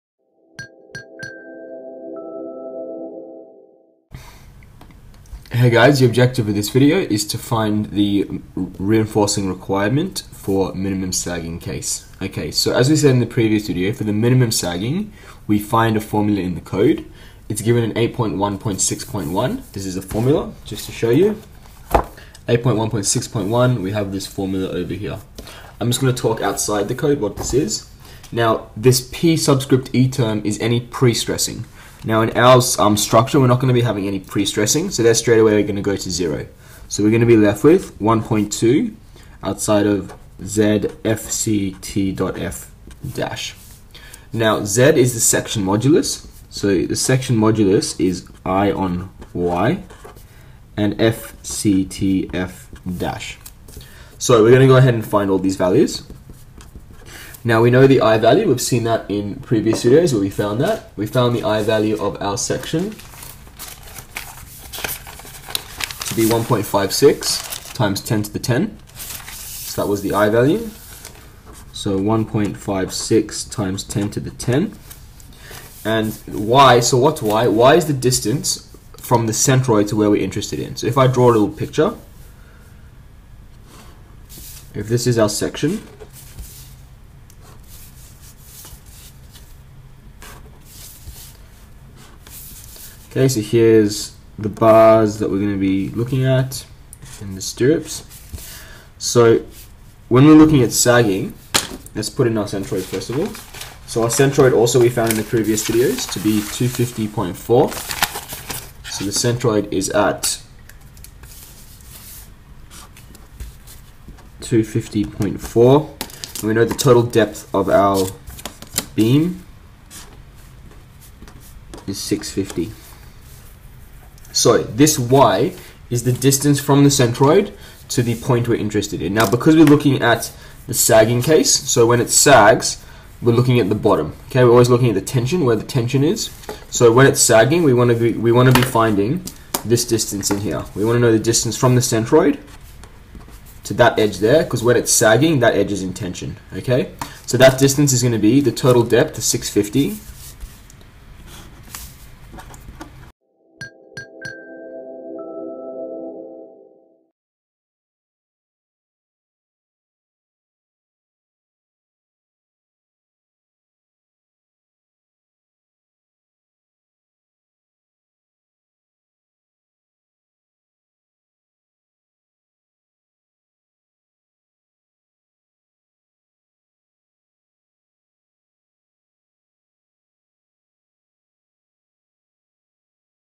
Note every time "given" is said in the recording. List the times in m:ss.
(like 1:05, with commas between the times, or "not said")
0:17.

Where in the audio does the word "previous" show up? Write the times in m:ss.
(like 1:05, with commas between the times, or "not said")
0:13, 0:59, 1:45.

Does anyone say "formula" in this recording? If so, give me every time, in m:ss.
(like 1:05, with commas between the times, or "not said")
0:16, 0:20, 0:24.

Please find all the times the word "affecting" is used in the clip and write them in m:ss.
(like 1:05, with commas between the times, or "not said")
not said.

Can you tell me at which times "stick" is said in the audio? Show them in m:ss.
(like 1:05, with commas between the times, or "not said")
not said.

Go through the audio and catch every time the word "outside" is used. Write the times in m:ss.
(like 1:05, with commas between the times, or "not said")
0:26, 0:39.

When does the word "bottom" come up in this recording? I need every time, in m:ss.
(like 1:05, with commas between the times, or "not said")
2:13.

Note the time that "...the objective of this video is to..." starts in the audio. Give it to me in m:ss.
0:05.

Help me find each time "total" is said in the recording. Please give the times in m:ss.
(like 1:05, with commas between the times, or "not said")
1:56, 2:28.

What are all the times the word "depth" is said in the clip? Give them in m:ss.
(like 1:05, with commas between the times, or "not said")
1:57, 2:28.